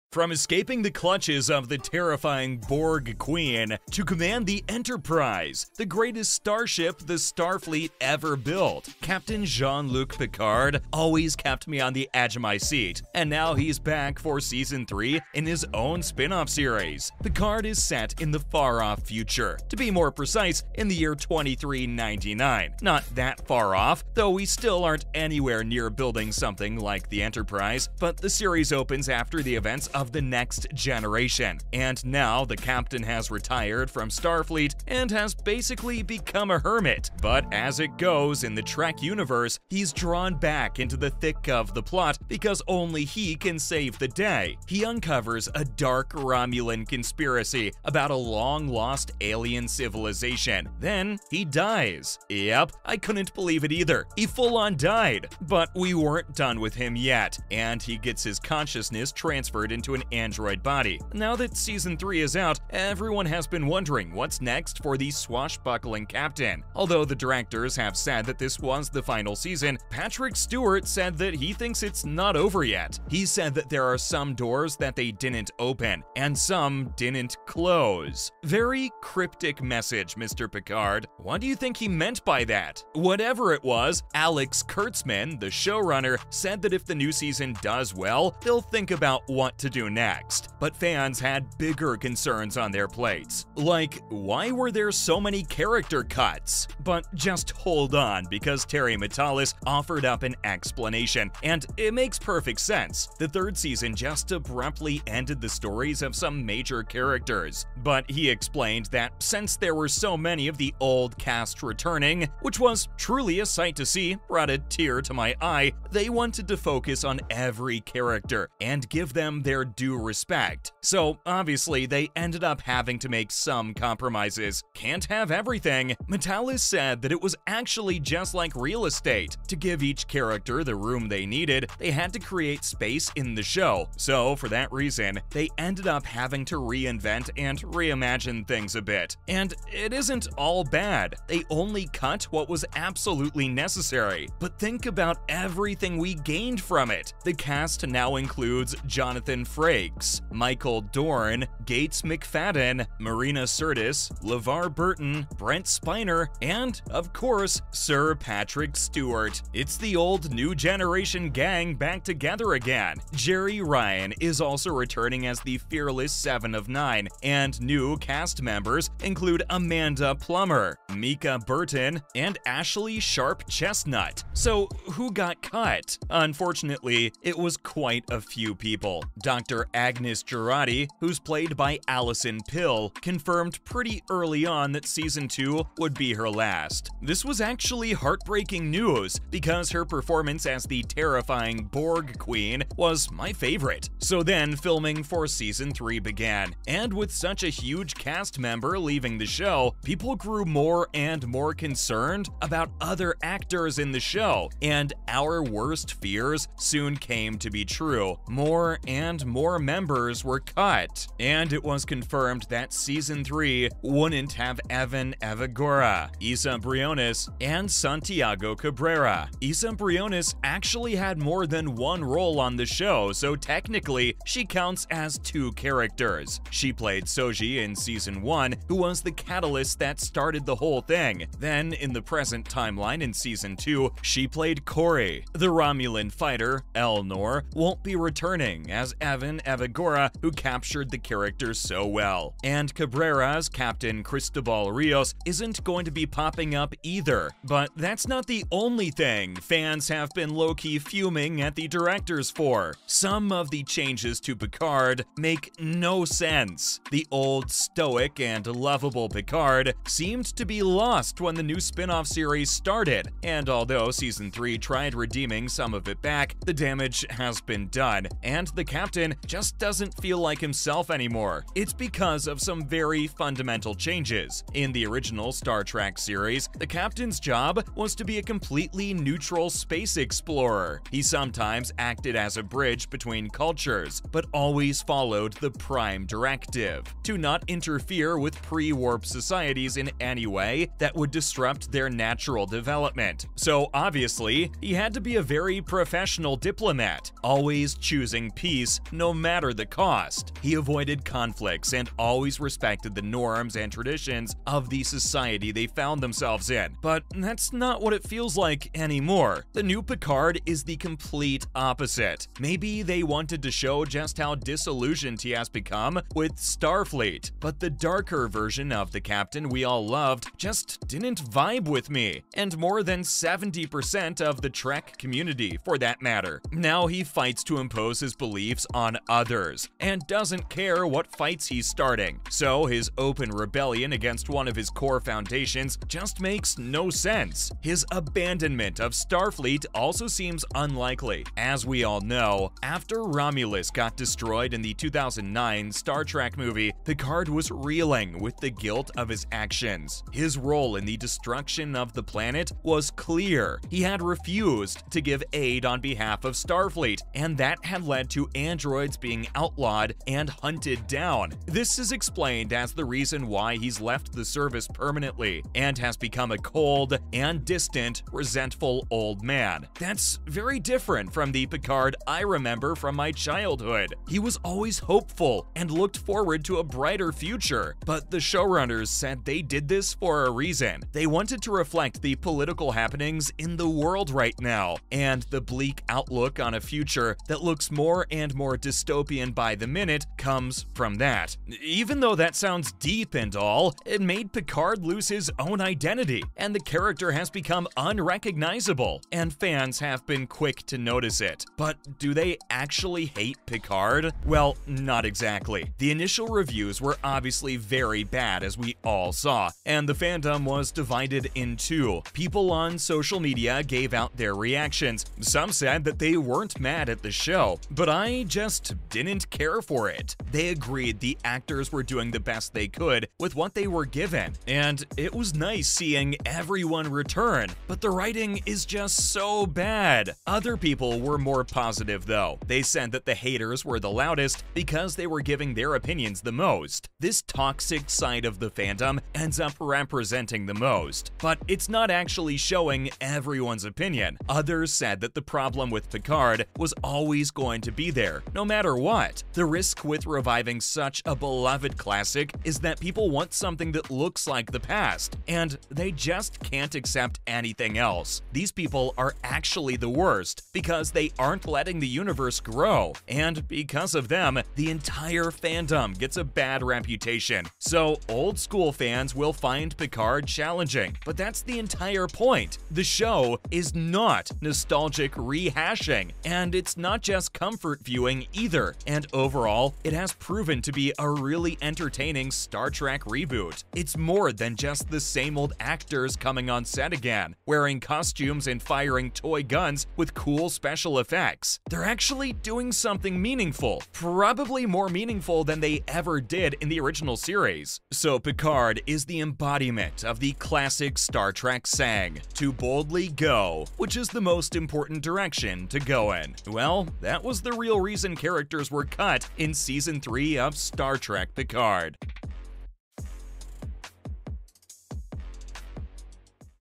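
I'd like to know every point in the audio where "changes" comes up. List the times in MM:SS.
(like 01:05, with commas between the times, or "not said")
04:13, 04:33.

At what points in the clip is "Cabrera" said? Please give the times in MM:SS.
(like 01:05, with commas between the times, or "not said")
03:38, 04:02.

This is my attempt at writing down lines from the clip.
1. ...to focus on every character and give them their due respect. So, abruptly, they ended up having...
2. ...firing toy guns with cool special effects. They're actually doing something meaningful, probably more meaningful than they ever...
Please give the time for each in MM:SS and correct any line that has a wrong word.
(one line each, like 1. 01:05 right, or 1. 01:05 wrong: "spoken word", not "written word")
1. 01:56 wrong: "obviously", not "abruptly"
2. 08:08 right.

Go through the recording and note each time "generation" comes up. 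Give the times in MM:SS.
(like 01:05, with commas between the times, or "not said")
00:30, 02:40.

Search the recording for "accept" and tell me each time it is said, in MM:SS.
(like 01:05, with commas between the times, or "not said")
07:36.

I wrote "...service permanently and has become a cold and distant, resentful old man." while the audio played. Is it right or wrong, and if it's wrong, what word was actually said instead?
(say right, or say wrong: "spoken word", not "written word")
right.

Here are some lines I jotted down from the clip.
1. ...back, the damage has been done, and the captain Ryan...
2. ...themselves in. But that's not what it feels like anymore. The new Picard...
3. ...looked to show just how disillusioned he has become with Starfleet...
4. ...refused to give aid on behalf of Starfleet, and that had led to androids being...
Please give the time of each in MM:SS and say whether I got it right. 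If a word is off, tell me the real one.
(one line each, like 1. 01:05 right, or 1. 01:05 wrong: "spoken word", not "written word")
1. 04:26 right
2. 05:06 right
3. 05:13 wrong: "wanted", not "looked"
4. 05:54 right.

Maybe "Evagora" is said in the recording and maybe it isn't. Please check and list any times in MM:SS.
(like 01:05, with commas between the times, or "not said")
03:35, 03:59.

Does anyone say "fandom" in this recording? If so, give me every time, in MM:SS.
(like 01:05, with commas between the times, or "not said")
06:49, 07:18, 07:45.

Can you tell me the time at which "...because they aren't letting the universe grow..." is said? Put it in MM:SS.
07:40.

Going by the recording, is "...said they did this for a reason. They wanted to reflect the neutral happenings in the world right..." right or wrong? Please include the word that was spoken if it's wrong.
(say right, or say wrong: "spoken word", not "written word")
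wrong: "political", not "neutral".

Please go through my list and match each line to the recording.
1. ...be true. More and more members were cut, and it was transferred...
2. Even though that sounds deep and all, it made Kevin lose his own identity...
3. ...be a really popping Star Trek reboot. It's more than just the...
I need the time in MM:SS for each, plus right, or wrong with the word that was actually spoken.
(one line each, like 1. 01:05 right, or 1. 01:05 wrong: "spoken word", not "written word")
1. 03:27 wrong: "confirmed", not "transferred"
2. 06:31 wrong: "Picard", not "Kevin"
3. 08:00 wrong: "entertaining", not "popping".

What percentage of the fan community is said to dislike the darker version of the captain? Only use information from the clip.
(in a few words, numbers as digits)
70%.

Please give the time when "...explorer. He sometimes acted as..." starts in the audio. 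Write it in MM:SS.
04:39.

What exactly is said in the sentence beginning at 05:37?
His abandonment of Starfleet also seems unlikely.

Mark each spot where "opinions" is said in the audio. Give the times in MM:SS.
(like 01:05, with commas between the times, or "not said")
07:15, 07:23.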